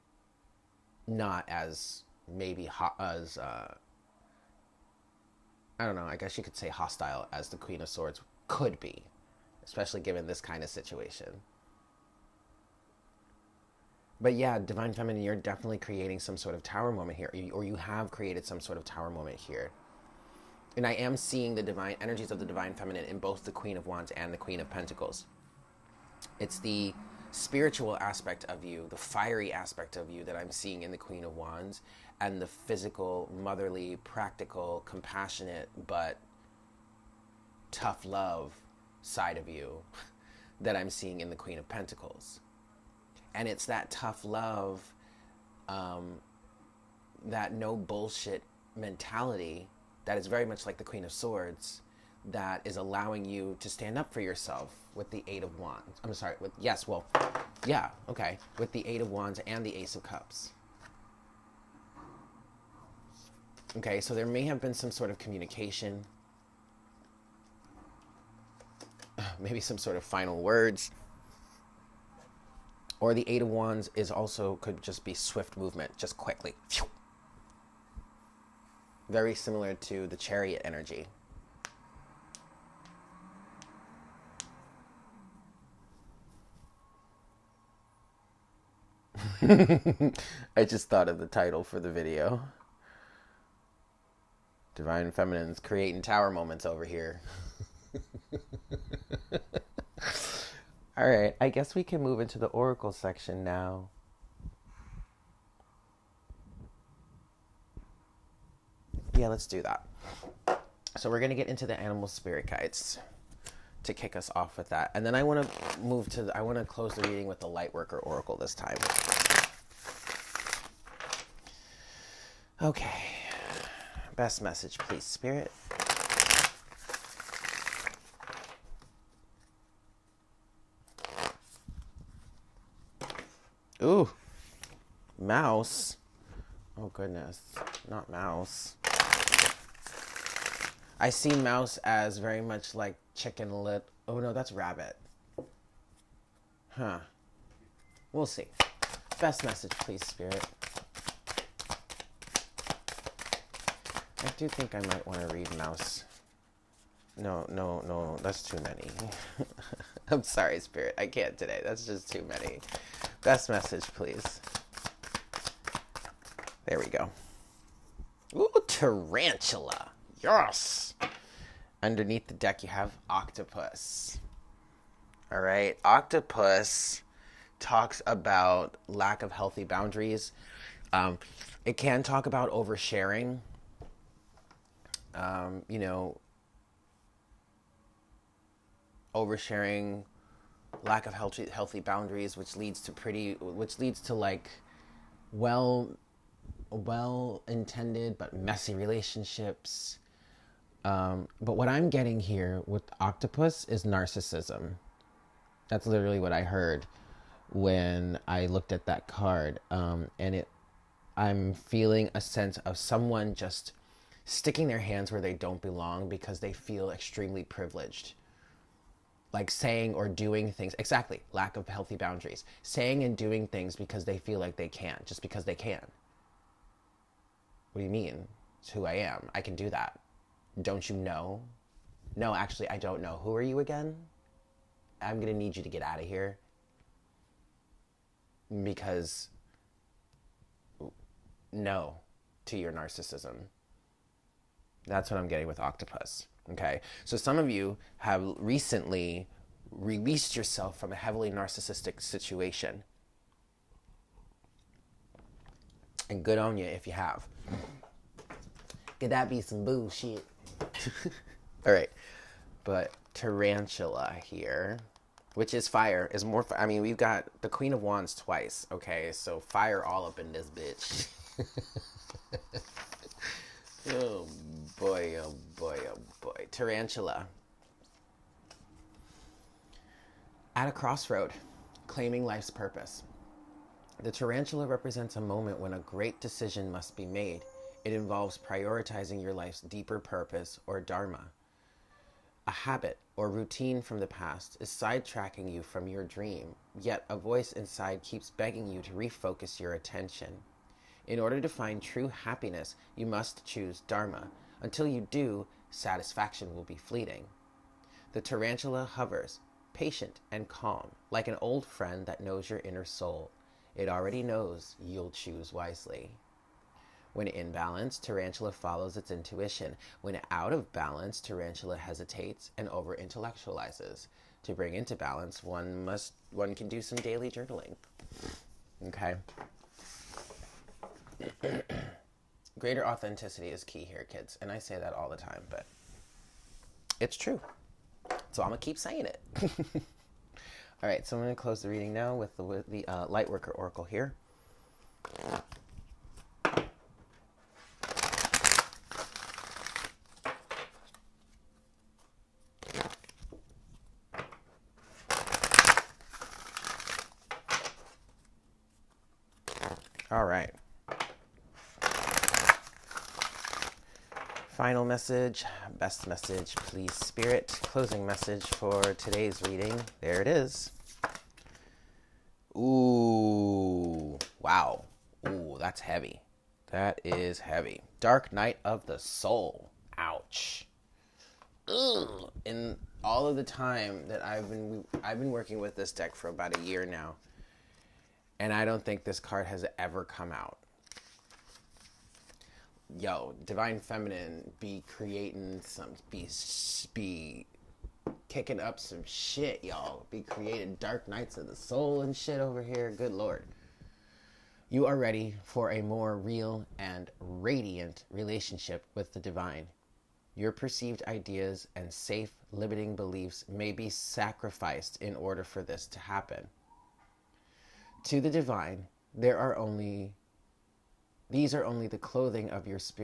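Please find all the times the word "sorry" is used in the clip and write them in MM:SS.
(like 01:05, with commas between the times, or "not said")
00:56, 02:40.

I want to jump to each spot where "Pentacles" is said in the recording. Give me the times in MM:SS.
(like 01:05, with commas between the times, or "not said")
00:24, 00:41.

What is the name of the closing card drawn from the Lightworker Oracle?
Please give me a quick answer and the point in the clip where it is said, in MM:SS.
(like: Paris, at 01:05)
Dark Night of the Soul, at 06:18.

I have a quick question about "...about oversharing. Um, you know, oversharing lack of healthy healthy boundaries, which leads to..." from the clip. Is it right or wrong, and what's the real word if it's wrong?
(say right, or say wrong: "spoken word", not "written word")
right.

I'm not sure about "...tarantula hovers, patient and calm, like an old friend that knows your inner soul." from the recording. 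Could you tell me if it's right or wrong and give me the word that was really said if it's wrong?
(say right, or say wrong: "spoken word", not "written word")
right.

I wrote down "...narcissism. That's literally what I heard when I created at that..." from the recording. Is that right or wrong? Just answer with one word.
wrong.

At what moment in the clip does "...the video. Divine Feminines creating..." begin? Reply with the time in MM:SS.
01:31.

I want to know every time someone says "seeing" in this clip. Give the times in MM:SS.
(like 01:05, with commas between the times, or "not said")
00:21, 00:30, 00:40.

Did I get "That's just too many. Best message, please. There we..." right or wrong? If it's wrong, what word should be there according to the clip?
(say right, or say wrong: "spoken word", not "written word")
right.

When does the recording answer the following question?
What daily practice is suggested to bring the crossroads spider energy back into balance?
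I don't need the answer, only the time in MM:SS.
05:26.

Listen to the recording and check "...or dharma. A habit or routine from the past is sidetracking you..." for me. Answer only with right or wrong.
right.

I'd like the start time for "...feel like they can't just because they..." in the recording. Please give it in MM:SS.
03:44.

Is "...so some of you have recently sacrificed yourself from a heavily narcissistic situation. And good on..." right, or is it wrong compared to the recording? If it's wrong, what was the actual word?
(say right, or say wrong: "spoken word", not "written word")
wrong: "released", not "sacrificed".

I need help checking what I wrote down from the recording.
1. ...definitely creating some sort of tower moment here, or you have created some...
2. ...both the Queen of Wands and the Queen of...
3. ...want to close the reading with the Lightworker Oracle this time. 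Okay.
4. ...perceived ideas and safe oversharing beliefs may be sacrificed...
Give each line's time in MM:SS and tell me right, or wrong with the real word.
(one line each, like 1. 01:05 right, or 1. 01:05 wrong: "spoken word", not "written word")
1. 00:15 right
2. 00:23 right
3. 01:56 right
4. 06:50 wrong: "limiting", not "oversharing".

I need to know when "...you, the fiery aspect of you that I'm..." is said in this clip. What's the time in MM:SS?
00:28.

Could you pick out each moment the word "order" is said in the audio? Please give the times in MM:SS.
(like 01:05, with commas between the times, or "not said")
05:01, 06:55.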